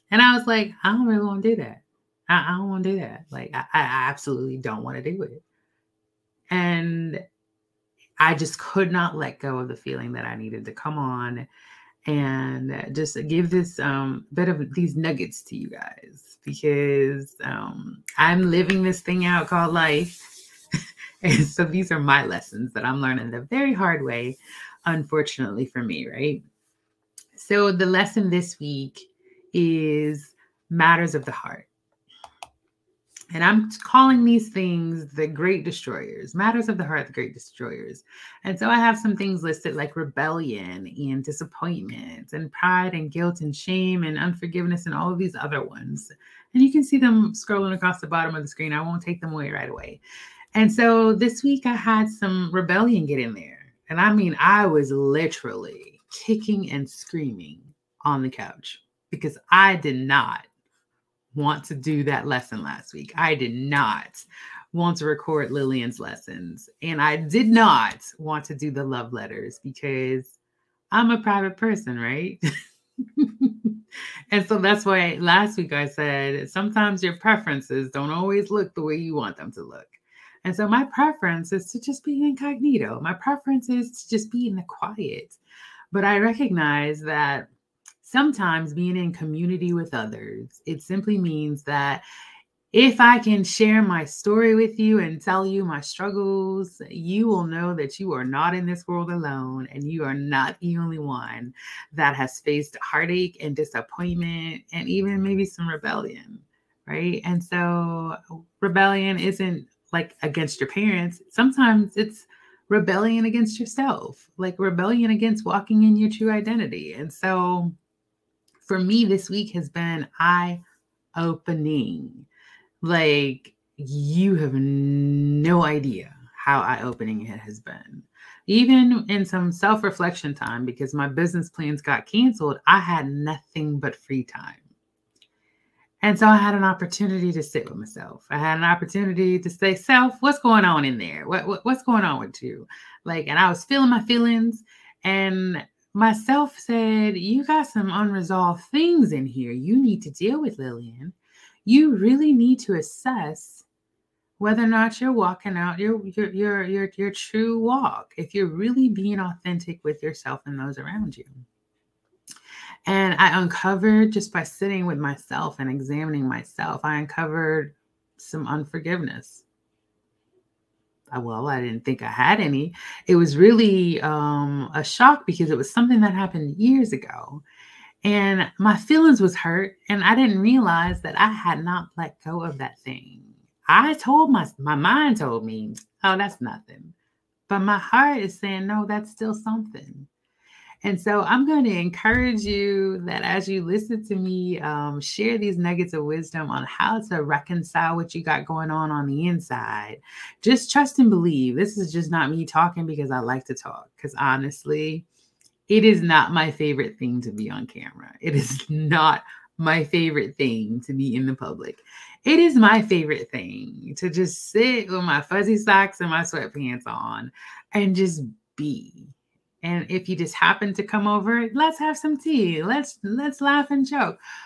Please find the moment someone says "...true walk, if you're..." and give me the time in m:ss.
2:37.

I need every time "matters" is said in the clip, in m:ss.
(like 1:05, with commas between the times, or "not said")
0:30, 0:36.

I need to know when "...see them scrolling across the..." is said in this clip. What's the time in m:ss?
0:46.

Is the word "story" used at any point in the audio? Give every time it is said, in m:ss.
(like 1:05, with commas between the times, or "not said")
1:34.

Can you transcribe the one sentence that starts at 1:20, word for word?
And so my preference is to just be incognito.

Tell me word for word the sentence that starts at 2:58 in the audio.
And my feelings was hurt, and I didn't realize that I had not let go of that thing.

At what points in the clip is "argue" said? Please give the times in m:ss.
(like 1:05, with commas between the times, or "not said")
not said.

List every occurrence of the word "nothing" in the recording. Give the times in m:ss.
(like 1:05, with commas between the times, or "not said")
2:13, 3:06.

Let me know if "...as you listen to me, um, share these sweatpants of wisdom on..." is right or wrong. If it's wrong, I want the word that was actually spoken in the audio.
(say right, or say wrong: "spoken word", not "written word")
wrong: "nuggets", not "sweatpants".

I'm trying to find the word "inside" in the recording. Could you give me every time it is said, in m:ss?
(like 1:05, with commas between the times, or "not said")
3:19.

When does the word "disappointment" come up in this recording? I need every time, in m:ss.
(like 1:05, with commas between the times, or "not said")
0:41, 1:43.